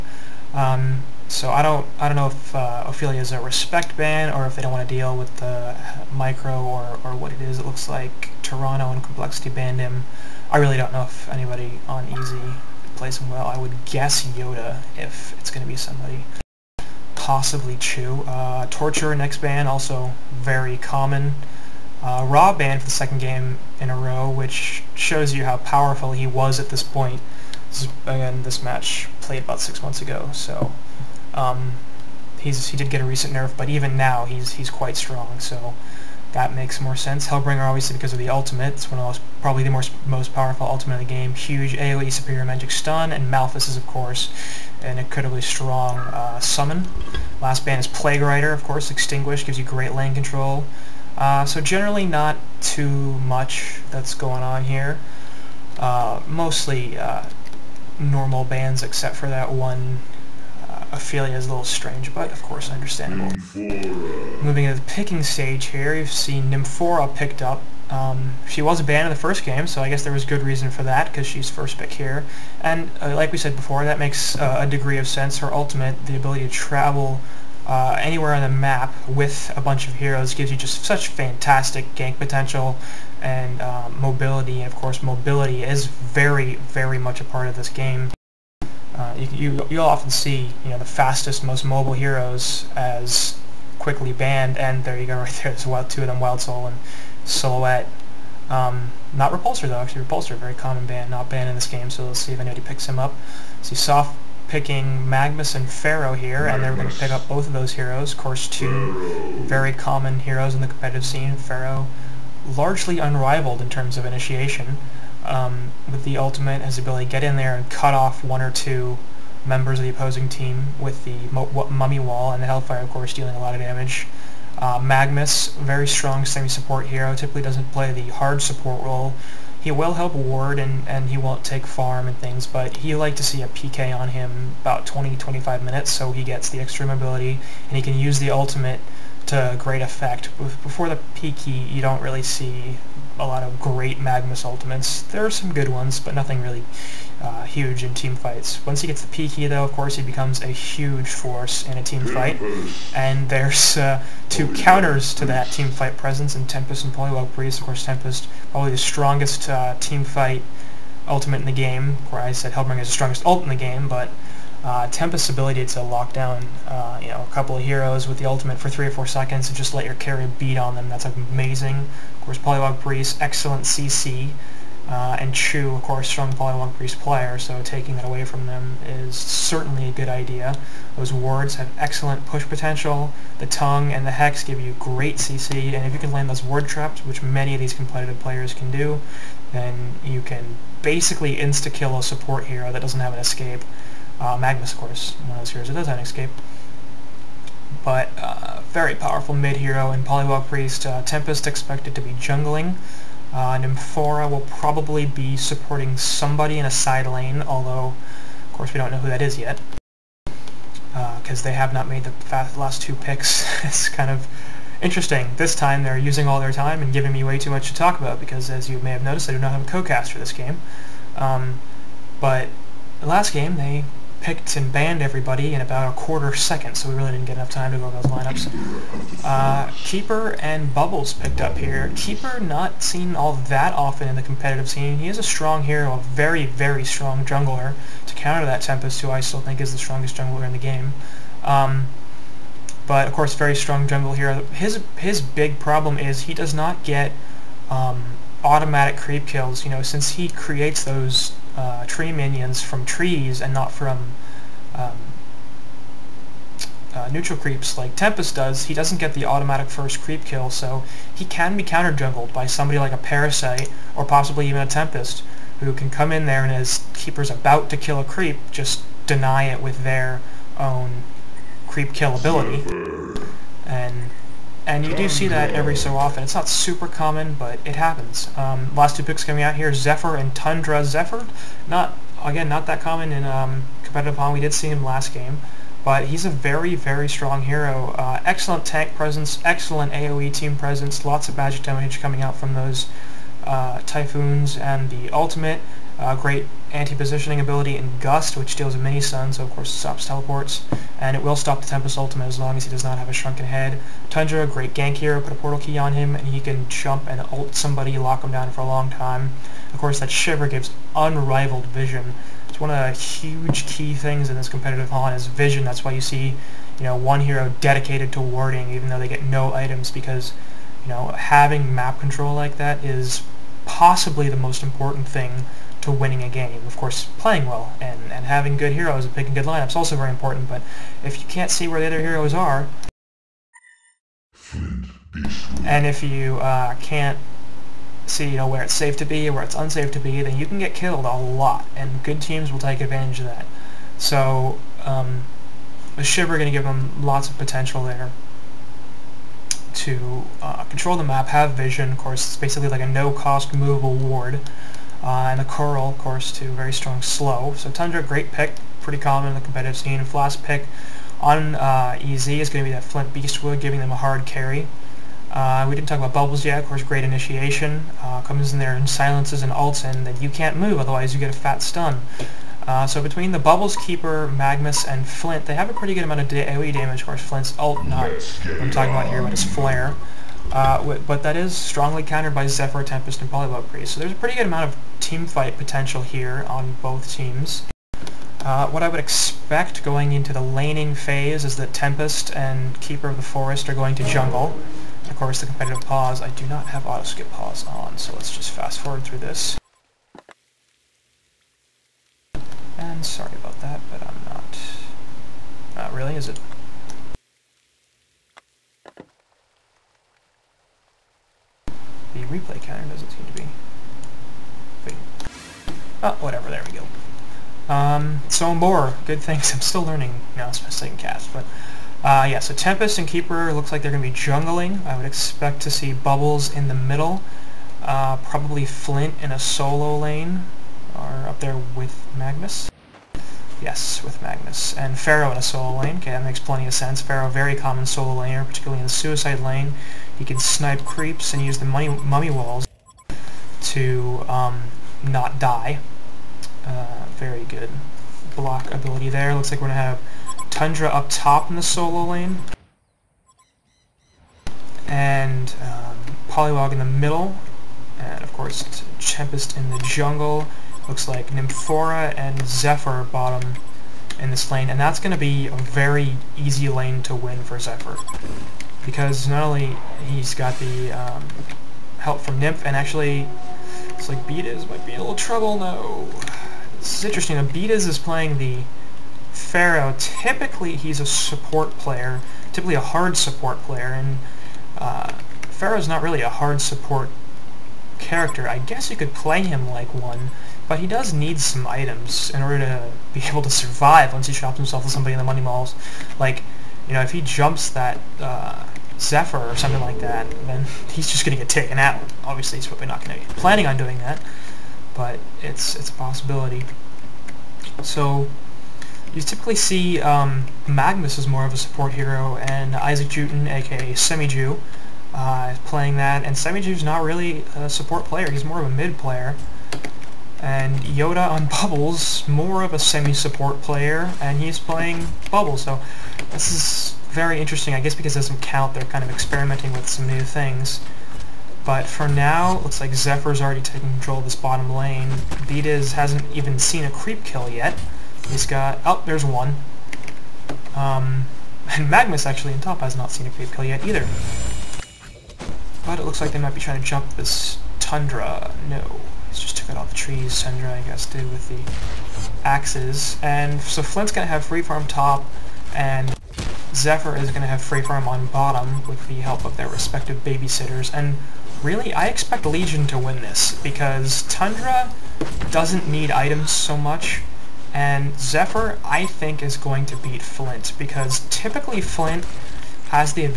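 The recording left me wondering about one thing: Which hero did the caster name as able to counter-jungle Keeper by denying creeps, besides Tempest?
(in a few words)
Parasite.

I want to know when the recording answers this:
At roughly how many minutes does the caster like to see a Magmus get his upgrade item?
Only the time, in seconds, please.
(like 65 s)
134 s.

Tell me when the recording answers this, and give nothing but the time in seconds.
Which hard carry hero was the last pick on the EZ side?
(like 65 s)
362 s.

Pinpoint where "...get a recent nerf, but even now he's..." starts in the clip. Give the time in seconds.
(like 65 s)
32 s.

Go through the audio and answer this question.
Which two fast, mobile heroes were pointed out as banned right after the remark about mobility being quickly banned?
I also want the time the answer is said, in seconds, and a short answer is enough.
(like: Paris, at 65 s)
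Wild Soul and Silhouette, at 96 s.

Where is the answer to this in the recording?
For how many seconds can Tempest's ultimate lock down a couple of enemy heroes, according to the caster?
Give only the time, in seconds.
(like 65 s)
168 s.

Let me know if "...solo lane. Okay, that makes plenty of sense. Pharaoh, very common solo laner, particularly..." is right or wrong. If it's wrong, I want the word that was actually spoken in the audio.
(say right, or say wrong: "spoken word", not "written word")
right.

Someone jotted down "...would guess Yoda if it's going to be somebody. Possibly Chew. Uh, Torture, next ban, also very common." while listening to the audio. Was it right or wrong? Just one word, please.
right.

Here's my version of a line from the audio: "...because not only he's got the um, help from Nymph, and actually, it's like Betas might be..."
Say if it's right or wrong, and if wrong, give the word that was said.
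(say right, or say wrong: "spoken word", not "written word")
right.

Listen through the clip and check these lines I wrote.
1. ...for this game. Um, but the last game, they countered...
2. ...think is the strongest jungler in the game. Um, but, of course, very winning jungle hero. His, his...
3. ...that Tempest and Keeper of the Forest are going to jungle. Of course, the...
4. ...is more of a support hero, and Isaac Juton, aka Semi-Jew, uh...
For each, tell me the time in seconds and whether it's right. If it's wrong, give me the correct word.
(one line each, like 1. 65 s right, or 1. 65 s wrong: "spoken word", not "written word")
1. 220 s wrong: "picked", not "countered"
2. 239 s wrong: "strong", not "winning"
3. 391 s right
4. 511 s right.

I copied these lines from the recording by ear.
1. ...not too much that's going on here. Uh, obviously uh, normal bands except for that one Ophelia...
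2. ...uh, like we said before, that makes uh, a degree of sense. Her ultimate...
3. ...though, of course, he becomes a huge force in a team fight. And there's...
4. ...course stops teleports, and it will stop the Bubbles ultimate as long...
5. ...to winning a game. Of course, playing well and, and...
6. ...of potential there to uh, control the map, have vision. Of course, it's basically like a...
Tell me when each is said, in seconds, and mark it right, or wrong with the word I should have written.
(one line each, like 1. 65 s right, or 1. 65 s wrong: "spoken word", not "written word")
1. 52 s wrong: "mostly", not "obviously"
2. 73 s right
3. 149 s right
4. 299 s wrong: "Tempest", not "Bubbles"
5. 325 s right
6. 347 s right.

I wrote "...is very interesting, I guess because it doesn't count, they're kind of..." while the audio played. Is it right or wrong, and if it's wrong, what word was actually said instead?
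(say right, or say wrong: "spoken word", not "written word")
right.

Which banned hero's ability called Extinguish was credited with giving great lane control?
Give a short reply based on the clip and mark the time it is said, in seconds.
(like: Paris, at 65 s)
Plague Rider, at 47 s.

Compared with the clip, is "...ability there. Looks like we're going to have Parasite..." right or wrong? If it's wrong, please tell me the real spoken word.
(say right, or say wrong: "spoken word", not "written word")
wrong: "Tundra", not "Parasite".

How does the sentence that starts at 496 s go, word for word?
Like, you know, if he jumps that uh, Zephyr or something like that, then he's just going to get taken out.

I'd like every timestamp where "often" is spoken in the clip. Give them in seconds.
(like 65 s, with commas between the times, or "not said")
89 s, 233 s, 275 s.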